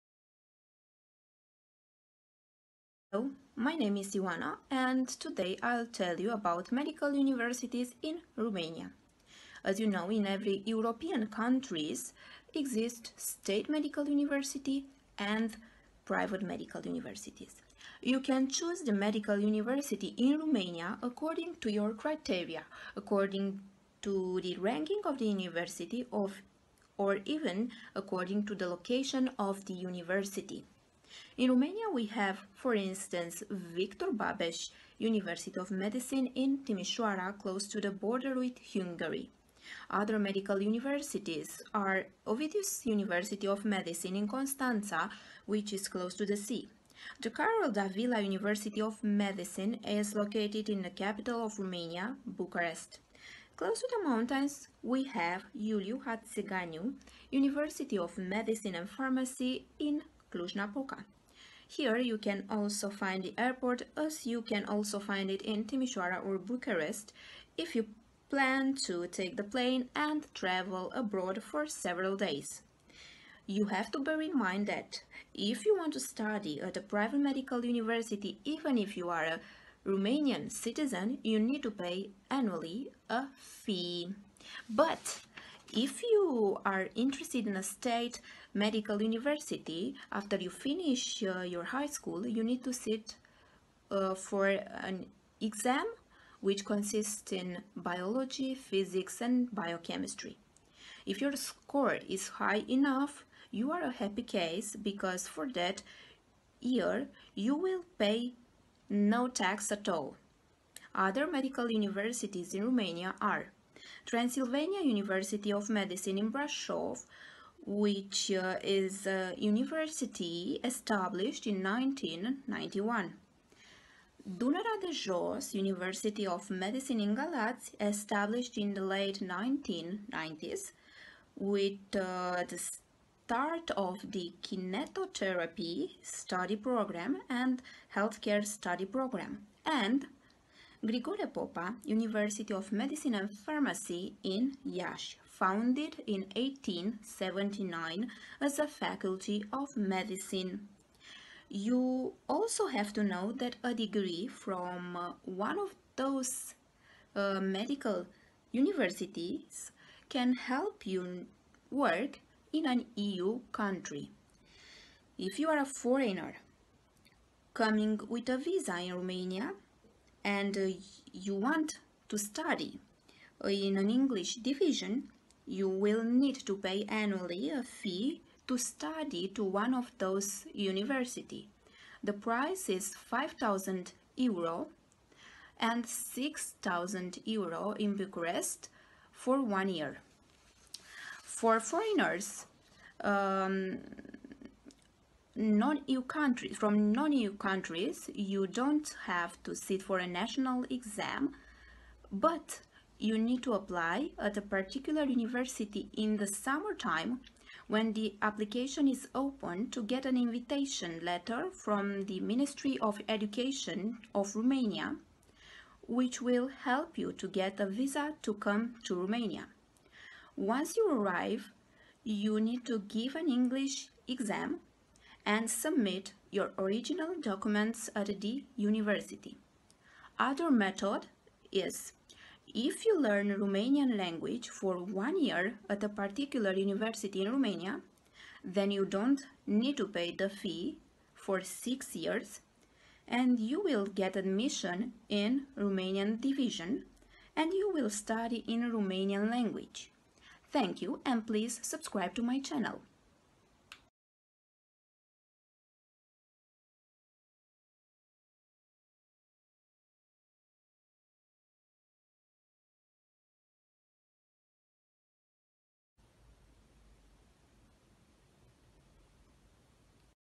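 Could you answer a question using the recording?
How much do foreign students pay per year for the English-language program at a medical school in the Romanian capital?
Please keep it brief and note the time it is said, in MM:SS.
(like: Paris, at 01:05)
6,000 euro, at 03:05.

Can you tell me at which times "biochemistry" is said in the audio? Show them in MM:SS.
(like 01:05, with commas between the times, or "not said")
01:39.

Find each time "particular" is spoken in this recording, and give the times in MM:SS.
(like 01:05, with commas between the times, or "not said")
03:24, 03:55.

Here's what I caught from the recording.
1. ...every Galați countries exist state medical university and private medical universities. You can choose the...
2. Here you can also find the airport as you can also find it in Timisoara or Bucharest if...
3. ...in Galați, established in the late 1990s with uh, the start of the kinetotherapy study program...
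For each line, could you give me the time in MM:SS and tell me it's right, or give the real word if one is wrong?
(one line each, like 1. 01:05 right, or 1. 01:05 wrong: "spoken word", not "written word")
1. 00:10 wrong: "European", not "Galați"
2. 01:01 right
3. 02:07 right.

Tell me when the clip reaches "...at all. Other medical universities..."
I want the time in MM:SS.
01:49.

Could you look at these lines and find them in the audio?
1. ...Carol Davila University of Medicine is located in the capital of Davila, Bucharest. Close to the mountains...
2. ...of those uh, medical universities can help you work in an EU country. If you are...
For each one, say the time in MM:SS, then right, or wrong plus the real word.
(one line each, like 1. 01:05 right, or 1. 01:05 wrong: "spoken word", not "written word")
1. 00:47 wrong: "Romania", not "Davila"
2. 02:35 right.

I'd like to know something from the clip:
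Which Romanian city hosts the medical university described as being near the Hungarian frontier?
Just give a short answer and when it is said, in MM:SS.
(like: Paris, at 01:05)
Timișoara, at 00:36.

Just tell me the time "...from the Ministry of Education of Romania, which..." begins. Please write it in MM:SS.
03:31.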